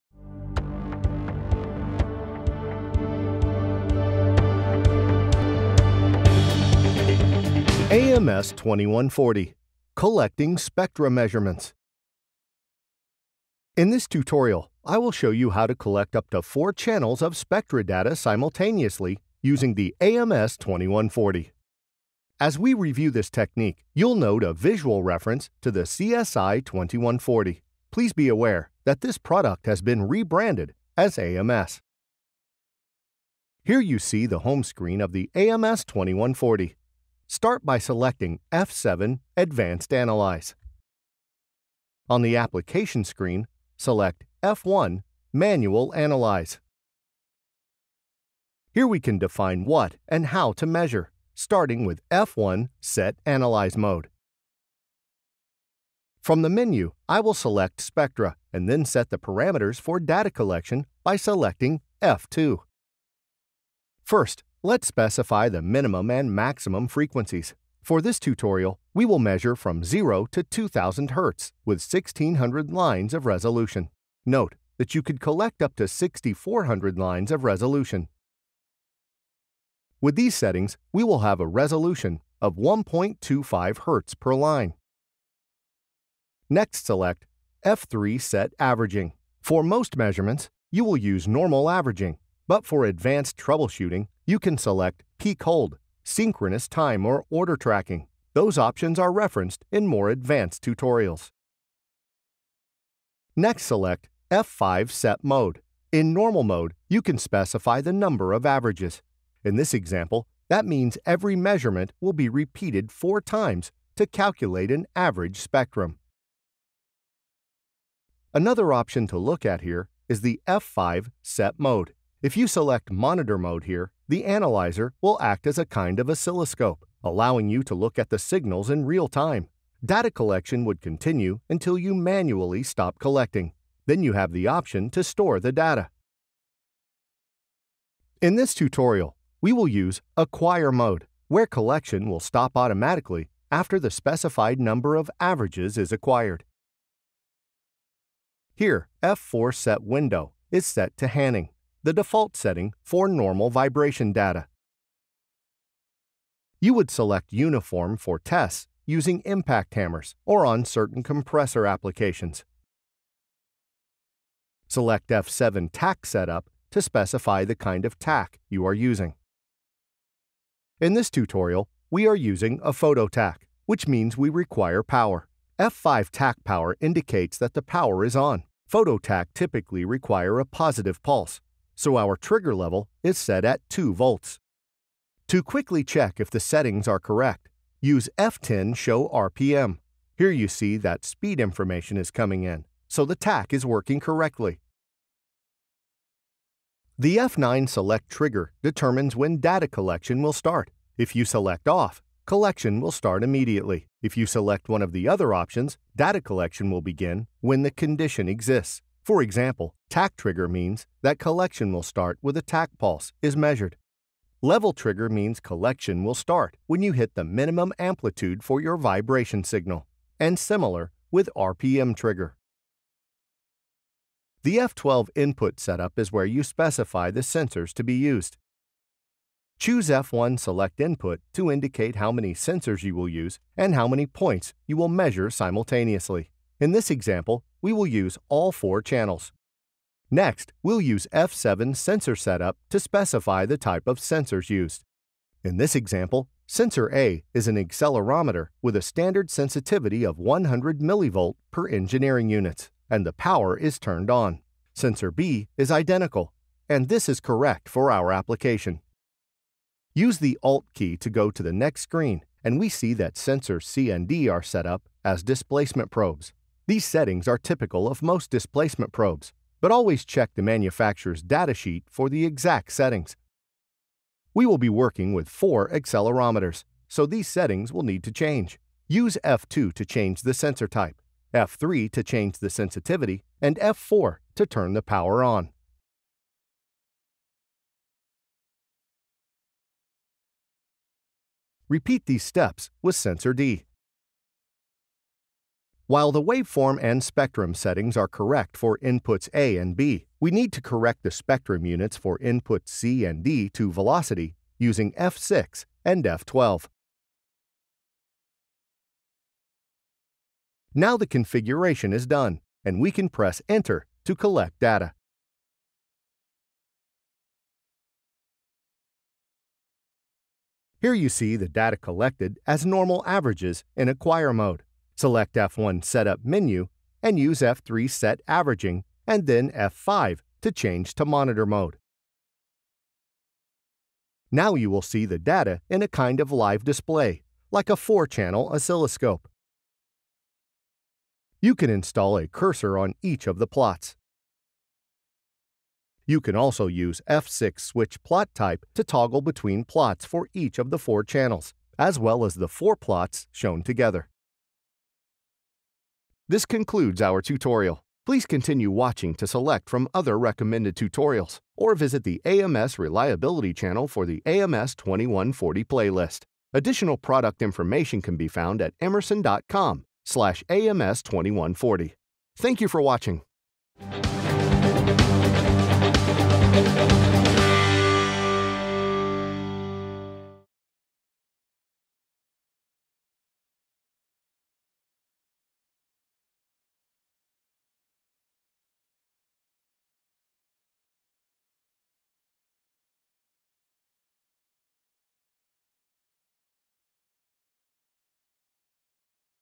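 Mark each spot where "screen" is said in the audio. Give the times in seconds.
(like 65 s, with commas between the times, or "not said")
34 s, 43 s, 261 s.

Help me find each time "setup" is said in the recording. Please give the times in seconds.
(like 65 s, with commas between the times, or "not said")
166 s, 225 s, 242 s, 325 s.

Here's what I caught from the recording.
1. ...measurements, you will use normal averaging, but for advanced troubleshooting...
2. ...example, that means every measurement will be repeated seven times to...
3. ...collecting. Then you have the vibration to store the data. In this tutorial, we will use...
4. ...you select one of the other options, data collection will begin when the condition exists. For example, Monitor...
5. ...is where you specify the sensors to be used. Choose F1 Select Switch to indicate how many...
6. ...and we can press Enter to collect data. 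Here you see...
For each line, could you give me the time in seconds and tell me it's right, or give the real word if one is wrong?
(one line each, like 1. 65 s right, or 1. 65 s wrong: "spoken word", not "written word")
1. 89 s right
2. 109 s wrong: "four", not "seven"
3. 132 s wrong: "option", not "vibration"
4. 204 s wrong: "Tach", not "Monitor"
5. 225 s wrong: "Input", not "Switch"
6. 312 s right.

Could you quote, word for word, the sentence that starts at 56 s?
From the menu, I will select Spectra and then set the parameters for data collection by selecting F2.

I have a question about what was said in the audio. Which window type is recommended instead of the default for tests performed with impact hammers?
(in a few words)
Uniform.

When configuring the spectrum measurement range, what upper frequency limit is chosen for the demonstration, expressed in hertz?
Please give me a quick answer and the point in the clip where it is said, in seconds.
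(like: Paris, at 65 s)
2000 Hz, at 70 s.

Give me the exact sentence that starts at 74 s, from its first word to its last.
Note that you could collect up to 6400 lines of resolution.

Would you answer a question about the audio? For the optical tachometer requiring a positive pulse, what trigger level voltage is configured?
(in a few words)
2 volts.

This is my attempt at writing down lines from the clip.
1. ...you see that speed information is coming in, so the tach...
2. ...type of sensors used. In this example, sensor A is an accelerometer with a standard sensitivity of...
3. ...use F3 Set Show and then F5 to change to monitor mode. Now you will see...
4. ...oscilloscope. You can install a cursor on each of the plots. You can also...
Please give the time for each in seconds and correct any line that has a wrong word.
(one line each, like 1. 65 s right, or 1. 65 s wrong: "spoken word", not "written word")
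1. 190 s right
2. 243 s right
3. 327 s wrong: "Averaging", not "Show"
4. 338 s right.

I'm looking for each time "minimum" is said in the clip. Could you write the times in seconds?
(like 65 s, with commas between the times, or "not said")
65 s, 217 s.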